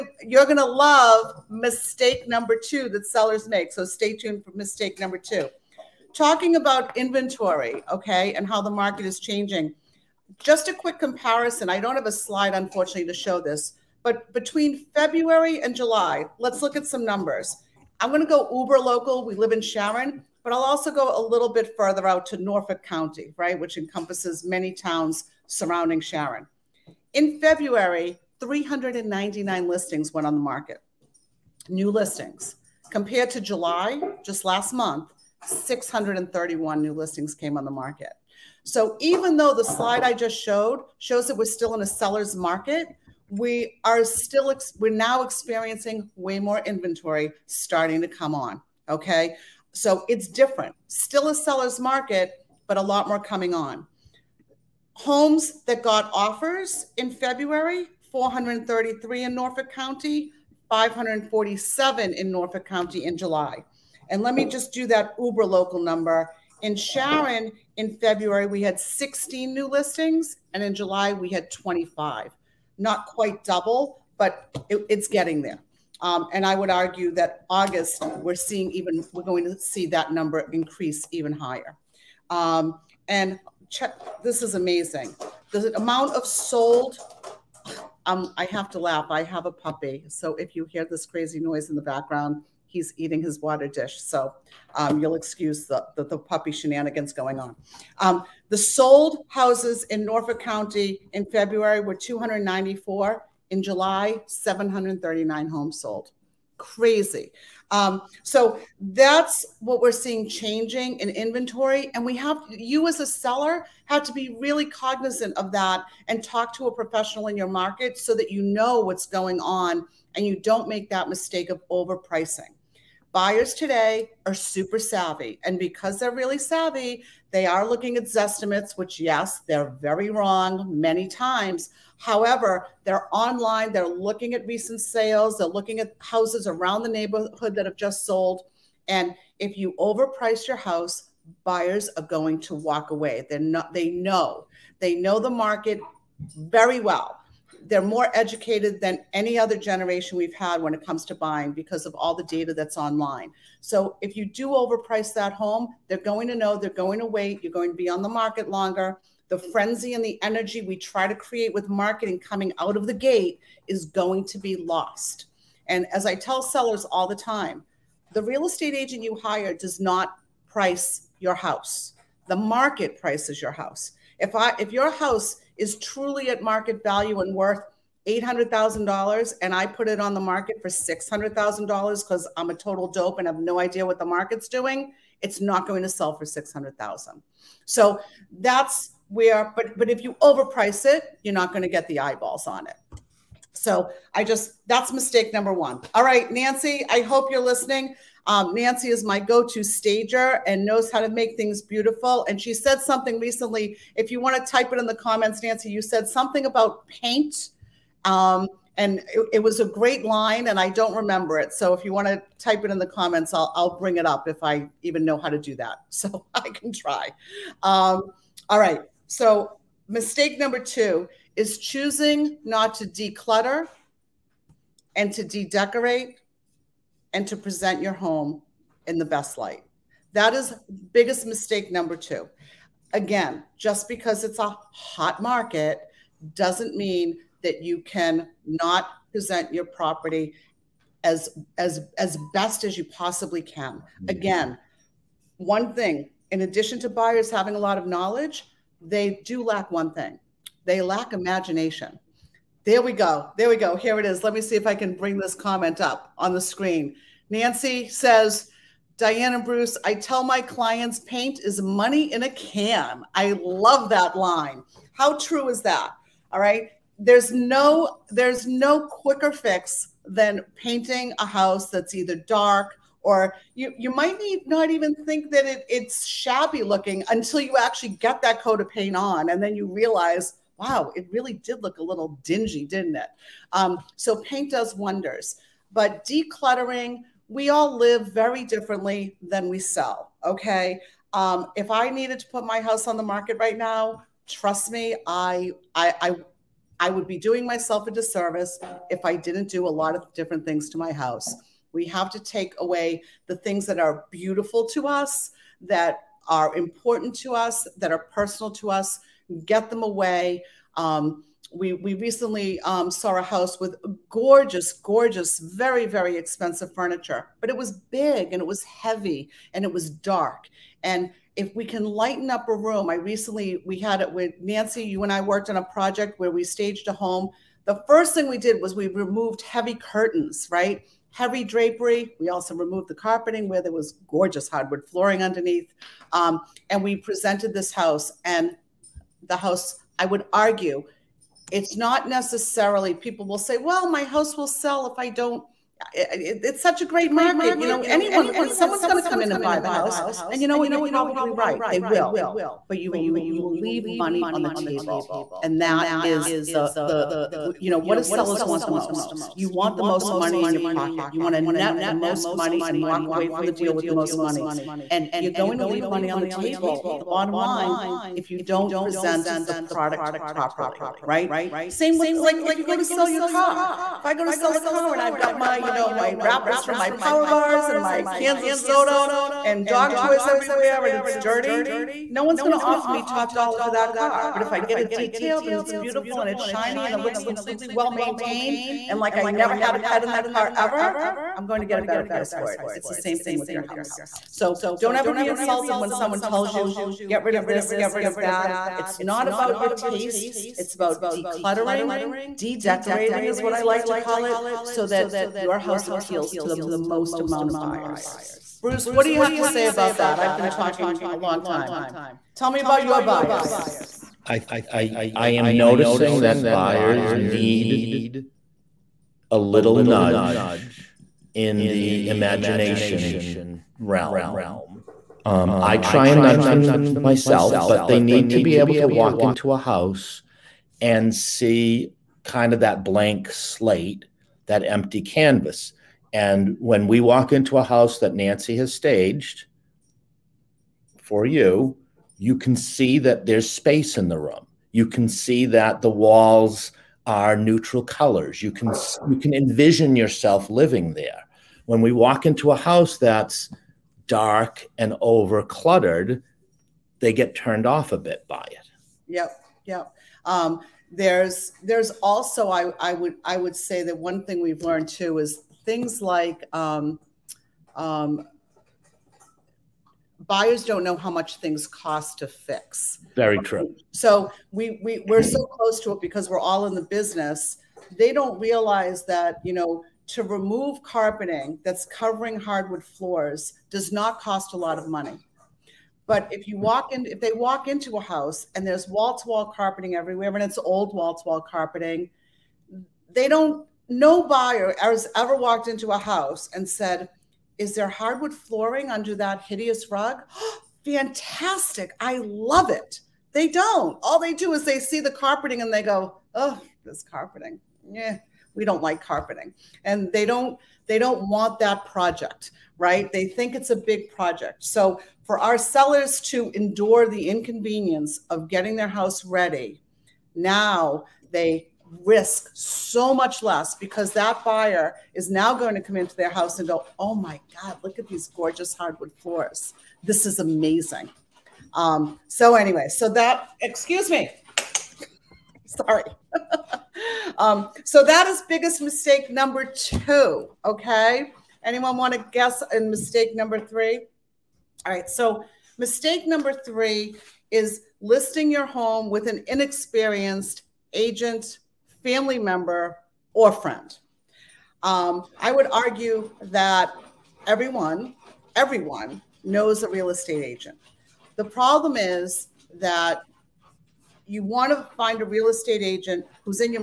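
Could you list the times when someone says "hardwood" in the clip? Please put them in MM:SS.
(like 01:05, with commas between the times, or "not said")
05:34, 08:02, 08:17, 08:48.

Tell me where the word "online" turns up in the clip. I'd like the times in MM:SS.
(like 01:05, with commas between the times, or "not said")
02:13, 02:32.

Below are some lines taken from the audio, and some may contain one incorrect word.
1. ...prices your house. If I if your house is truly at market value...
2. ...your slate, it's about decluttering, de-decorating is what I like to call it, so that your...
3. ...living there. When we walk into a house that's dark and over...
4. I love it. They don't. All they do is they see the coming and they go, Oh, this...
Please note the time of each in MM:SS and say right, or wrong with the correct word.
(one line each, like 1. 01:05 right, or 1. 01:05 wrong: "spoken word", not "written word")
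1. 02:53 right
2. 06:39 wrong: "taste", not "slate"
3. 07:30 right
4. 08:21 wrong: "carpeting", not "coming".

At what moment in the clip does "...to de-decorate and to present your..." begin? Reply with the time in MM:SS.
03:45.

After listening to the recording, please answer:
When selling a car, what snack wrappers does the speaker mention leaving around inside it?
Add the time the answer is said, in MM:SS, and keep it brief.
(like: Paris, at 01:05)
power bars, at 06:16.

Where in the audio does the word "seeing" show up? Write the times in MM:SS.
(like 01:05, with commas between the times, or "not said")
01:18, 01:49.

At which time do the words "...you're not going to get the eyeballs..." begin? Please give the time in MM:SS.
03:11.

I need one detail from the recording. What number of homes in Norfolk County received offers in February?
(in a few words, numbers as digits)
433.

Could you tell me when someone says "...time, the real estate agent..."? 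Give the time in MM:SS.
02:47.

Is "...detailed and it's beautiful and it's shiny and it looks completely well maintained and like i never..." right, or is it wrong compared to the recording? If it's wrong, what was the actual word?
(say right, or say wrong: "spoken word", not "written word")
right.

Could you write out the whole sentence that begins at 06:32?
It's the same thing with your house.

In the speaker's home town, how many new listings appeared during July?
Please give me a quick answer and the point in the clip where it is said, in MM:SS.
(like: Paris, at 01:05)
25, at 01:11.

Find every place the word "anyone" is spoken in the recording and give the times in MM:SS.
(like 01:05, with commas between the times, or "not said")
05:47, 09:01.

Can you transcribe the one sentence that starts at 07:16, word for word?
And when we walk into a house that Nancy has staged for you, you can see that there's space in the room.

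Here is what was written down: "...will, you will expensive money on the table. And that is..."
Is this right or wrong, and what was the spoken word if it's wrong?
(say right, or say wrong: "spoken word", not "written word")
wrong: "leave", not "expensive".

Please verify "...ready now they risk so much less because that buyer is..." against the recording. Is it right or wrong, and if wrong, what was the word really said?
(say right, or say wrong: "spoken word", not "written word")
right.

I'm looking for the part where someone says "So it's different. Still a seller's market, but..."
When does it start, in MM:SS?
00:49.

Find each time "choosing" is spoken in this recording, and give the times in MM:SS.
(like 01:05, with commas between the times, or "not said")
03:41.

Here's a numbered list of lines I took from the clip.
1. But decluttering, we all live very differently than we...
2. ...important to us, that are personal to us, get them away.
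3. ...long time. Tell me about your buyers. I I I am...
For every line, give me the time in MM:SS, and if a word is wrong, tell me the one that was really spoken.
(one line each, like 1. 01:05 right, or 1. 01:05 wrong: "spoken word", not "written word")
1. 04:45 right
2. 05:06 right
3. 06:51 right.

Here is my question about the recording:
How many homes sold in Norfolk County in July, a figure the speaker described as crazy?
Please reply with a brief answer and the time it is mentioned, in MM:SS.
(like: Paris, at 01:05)
739, at 01:44.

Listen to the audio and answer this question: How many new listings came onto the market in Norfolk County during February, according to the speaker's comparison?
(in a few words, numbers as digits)
399.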